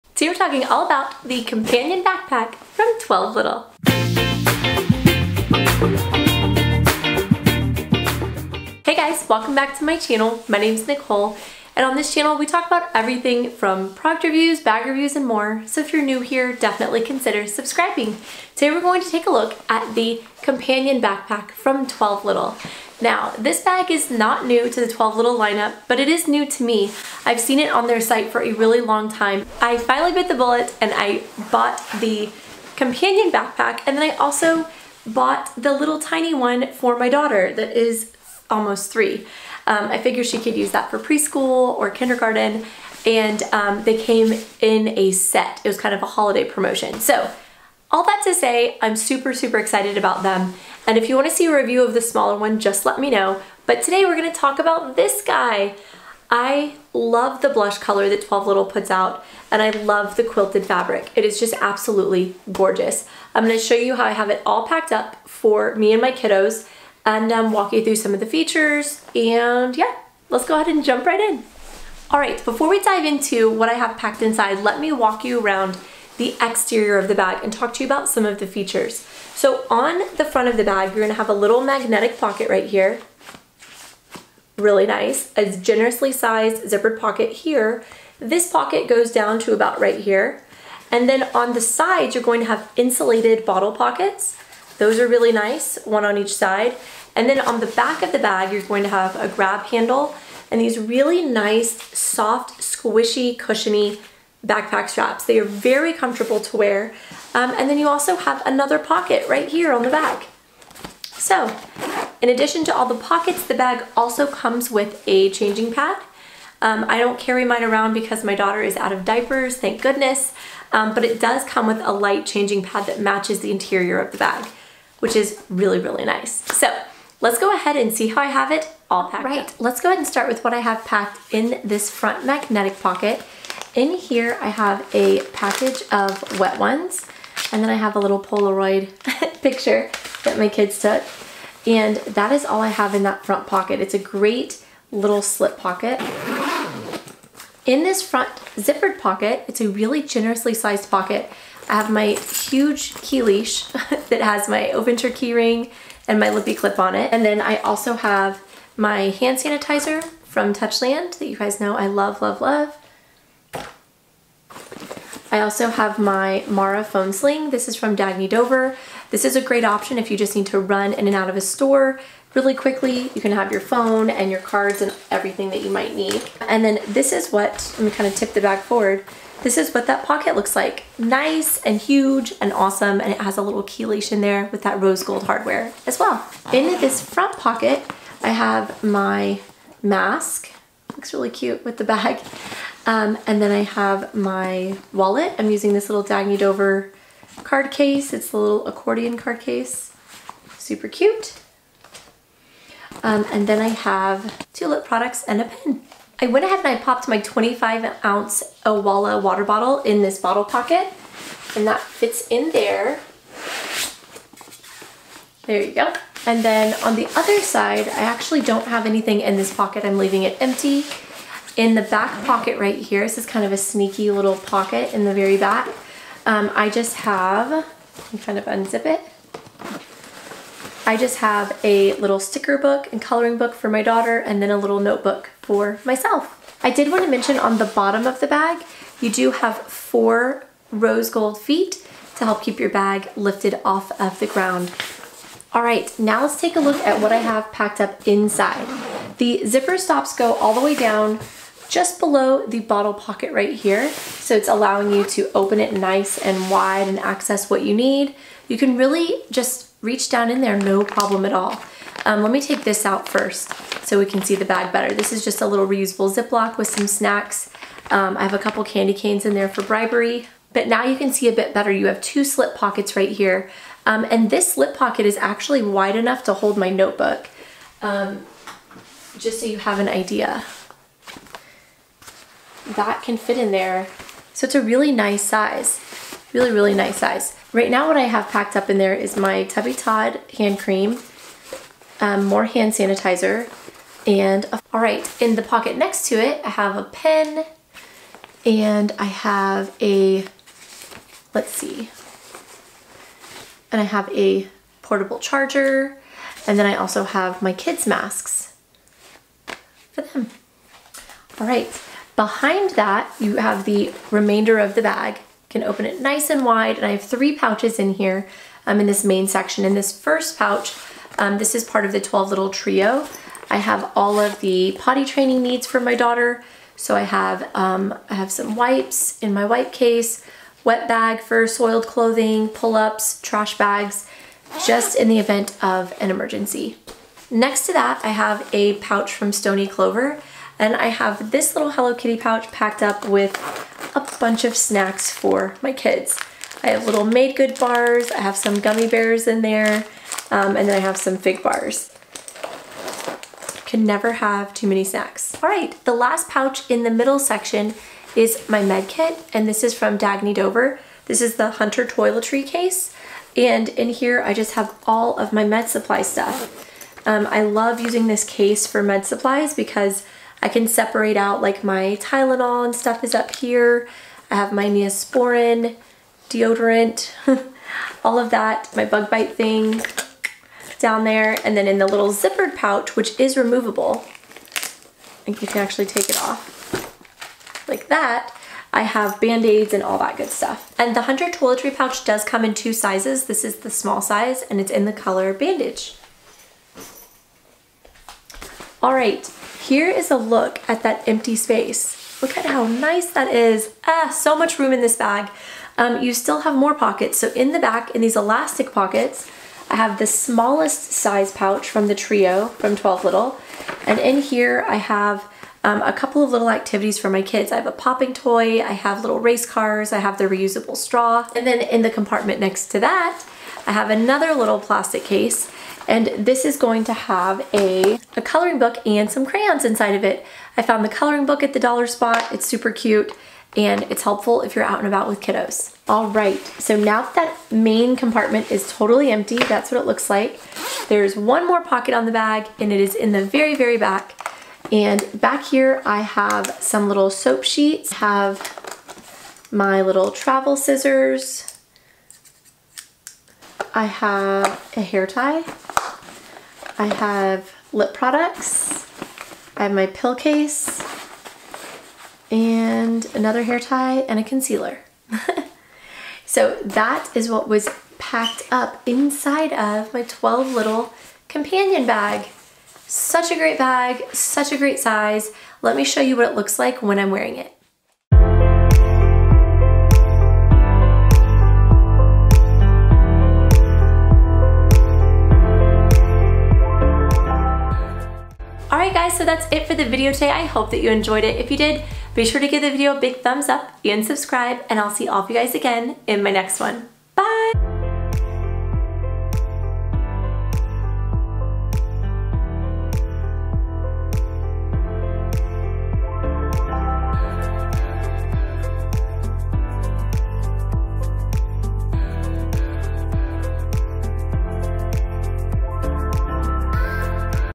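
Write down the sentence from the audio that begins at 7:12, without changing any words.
It's super cute and it's helpful if you're out and about with kiddos.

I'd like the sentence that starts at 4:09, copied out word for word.
The zipper stops go all the way down just below the bottle pocket right here.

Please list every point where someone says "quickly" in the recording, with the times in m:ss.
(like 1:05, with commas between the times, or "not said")
2:52.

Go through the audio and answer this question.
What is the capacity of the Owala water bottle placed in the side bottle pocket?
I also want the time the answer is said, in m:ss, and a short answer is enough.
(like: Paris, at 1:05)
25 ounces, at 3:27.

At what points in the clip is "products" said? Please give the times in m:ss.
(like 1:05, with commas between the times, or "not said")
0:13, 3:24, 7:37.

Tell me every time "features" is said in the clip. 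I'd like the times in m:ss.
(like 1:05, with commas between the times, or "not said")
1:08, 1:18.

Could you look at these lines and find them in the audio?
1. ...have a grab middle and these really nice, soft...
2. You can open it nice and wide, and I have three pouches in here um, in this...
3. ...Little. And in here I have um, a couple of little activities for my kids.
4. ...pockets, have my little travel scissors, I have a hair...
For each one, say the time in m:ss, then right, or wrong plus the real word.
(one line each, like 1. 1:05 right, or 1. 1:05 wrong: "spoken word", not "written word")
1. 1:38 wrong: "handle", not "middle"
2. 5:15 right
3. 6:53 right
4. 7:27 wrong: "sheets", not "pockets".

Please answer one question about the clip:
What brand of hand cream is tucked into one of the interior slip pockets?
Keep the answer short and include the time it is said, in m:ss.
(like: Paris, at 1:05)
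Tubby Todd, at 4:49.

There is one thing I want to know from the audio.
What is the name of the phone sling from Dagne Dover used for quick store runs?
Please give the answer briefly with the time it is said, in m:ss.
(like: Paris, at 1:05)
Mara Phone Sling, at 2:46.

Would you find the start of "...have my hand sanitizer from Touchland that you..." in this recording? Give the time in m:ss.
2:37.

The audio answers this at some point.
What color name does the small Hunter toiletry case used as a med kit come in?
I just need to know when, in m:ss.
6:35.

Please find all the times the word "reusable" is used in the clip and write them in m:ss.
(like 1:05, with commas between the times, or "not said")
4:25, 7:00.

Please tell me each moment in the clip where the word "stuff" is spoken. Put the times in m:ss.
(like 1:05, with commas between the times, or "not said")
6:06, 6:12, 6:30.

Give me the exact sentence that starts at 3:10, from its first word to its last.
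Looks really cute with the bag.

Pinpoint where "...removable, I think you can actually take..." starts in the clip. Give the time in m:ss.
6:23.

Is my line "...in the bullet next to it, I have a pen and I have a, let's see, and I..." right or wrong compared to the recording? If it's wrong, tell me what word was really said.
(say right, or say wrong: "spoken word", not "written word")
wrong: "pocket", not "bullet".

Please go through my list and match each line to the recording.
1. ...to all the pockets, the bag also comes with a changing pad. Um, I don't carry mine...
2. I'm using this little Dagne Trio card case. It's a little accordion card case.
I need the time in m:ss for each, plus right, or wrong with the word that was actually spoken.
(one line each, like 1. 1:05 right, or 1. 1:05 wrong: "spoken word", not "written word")
1. 1:52 right
2. 3:15 wrong: "Dover", not "Trio".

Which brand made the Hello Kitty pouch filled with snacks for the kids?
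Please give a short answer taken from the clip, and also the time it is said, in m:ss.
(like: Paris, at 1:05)
Stoney Clover, at 5:39.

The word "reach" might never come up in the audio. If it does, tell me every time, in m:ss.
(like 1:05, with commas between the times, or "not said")
4:19.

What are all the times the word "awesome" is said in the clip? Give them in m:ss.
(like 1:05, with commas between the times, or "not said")
3:02.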